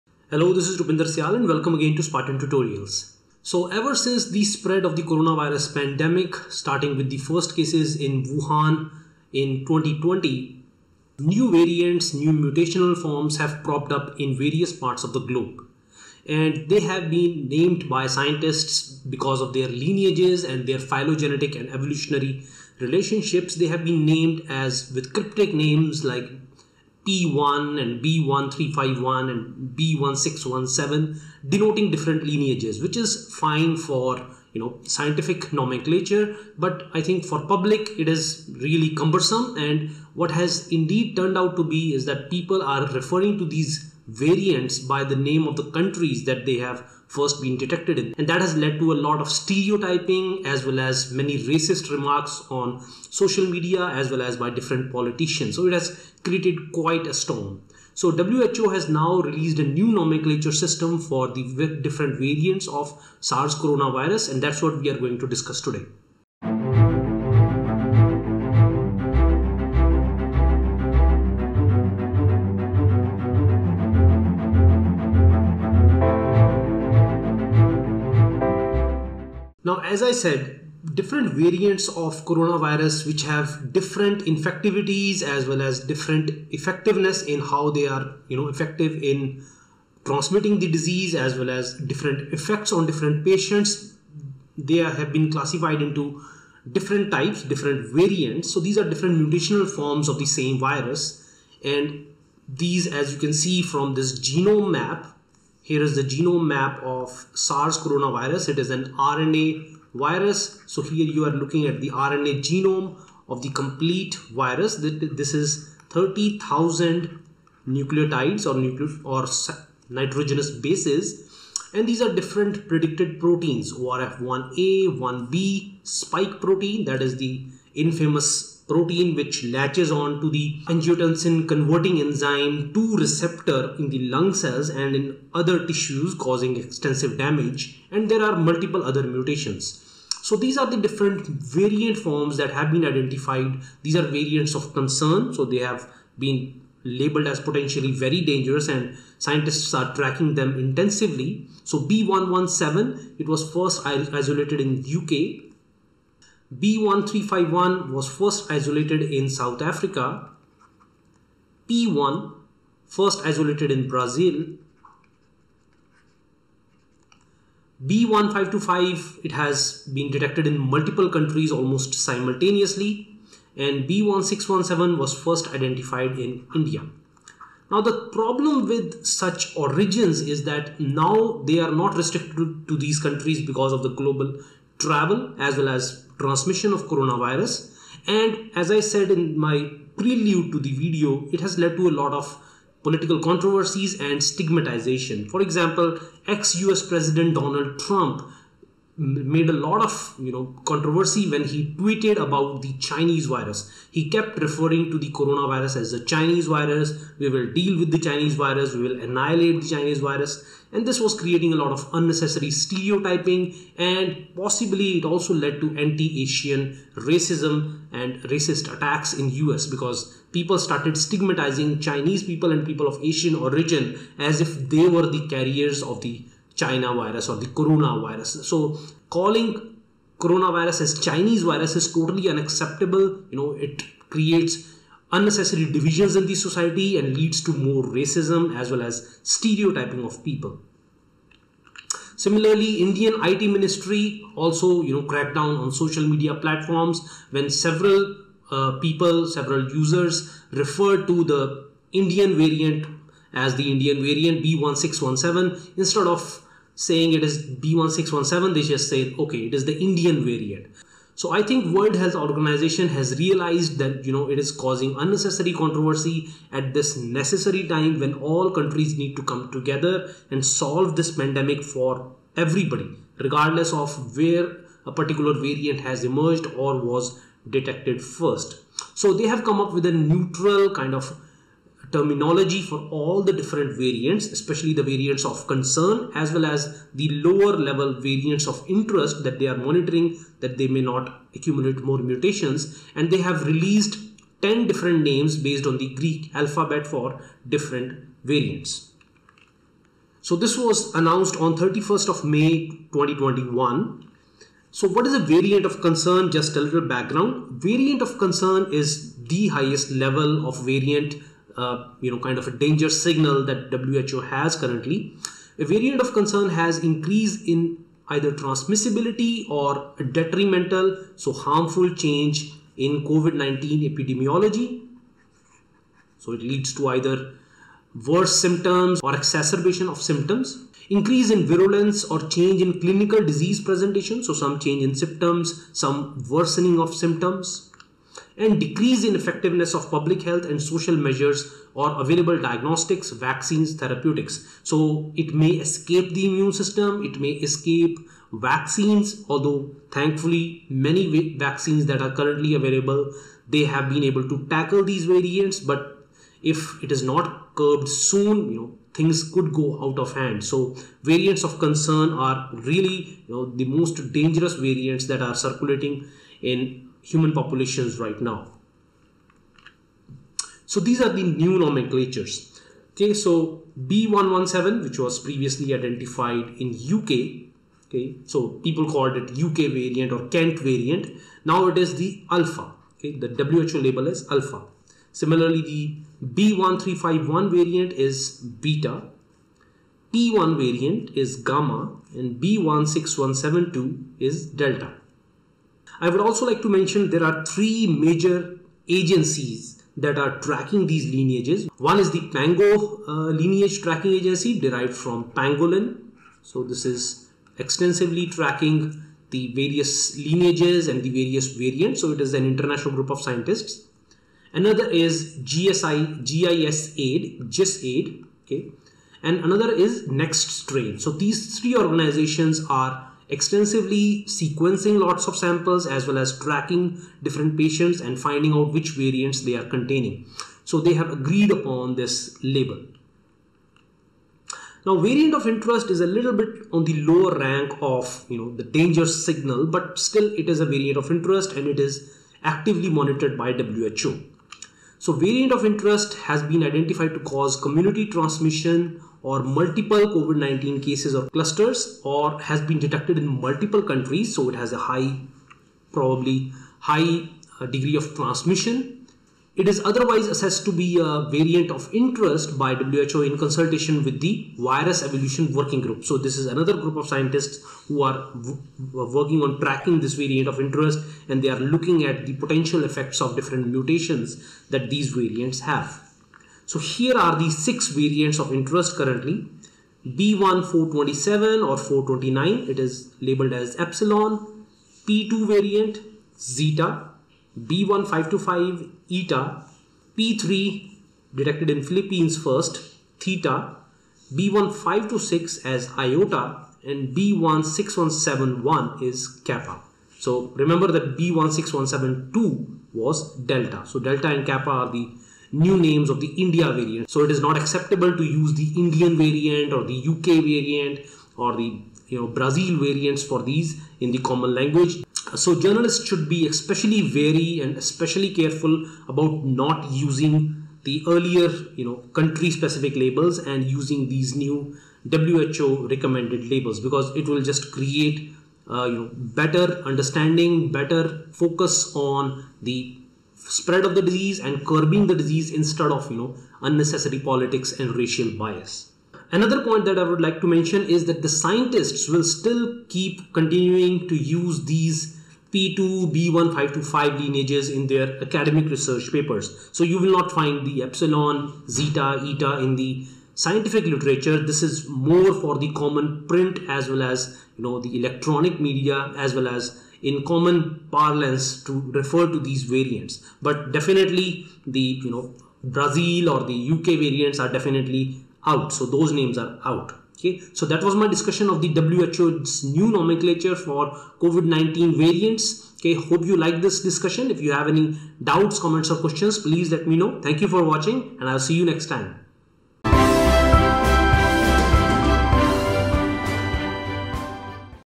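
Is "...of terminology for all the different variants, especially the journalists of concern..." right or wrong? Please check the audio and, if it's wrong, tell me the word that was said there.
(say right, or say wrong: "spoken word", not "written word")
wrong: "variants", not "journalists".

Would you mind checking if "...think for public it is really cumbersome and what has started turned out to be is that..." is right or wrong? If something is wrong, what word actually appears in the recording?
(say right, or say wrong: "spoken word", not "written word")
wrong: "indeed", not "started".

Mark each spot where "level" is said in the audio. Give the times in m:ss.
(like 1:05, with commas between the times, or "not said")
4:47, 5:09.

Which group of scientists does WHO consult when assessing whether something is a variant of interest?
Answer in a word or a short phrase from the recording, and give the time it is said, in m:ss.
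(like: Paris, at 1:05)
Virus Evolution Working Group, at 7:44.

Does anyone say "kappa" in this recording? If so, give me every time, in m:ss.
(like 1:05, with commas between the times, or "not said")
8:19, 8:24.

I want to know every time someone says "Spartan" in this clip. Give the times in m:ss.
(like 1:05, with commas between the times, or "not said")
0:02.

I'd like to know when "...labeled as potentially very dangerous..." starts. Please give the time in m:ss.
2:26.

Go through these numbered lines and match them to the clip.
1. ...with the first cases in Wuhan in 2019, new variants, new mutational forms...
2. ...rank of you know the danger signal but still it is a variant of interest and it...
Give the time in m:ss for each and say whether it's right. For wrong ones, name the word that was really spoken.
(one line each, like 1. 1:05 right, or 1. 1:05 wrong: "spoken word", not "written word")
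1. 0:06 wrong: "2020", not "2019"
2. 7:17 right.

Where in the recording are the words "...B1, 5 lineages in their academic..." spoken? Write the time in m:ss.
9:06.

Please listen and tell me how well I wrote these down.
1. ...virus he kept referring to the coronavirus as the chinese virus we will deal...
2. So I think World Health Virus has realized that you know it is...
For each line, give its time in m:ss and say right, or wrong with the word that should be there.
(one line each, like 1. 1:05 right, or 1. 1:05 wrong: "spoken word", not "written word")
1. 3:23 right
2. 4:21 wrong: "Organization", not "Virus".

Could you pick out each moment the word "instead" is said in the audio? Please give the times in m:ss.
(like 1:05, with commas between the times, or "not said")
4:15, 8:55.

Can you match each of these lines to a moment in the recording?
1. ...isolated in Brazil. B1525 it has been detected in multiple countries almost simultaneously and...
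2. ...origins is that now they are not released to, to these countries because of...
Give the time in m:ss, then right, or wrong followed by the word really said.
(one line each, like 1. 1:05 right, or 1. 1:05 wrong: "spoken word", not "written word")
1. 2:43 right
2. 2:59 wrong: "restricted", not "released".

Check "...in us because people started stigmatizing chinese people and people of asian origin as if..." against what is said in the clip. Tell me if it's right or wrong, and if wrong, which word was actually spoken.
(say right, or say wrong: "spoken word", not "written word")
right.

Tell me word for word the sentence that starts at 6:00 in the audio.
So variants of concern are really you know, the most dangerous variants that are circulating in human populations right now.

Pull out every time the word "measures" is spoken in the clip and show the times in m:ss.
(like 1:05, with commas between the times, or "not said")
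5:40.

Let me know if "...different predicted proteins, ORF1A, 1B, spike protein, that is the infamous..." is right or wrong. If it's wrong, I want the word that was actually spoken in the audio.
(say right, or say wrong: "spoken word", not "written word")
right.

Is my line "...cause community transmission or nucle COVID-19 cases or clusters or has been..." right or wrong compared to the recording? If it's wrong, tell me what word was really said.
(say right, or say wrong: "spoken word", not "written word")
wrong: "multiple", not "nucle".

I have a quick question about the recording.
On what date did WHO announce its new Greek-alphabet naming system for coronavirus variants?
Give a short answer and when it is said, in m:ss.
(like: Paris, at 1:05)
31 May 2021, at 5:01.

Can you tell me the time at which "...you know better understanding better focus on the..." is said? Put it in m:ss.
8:48.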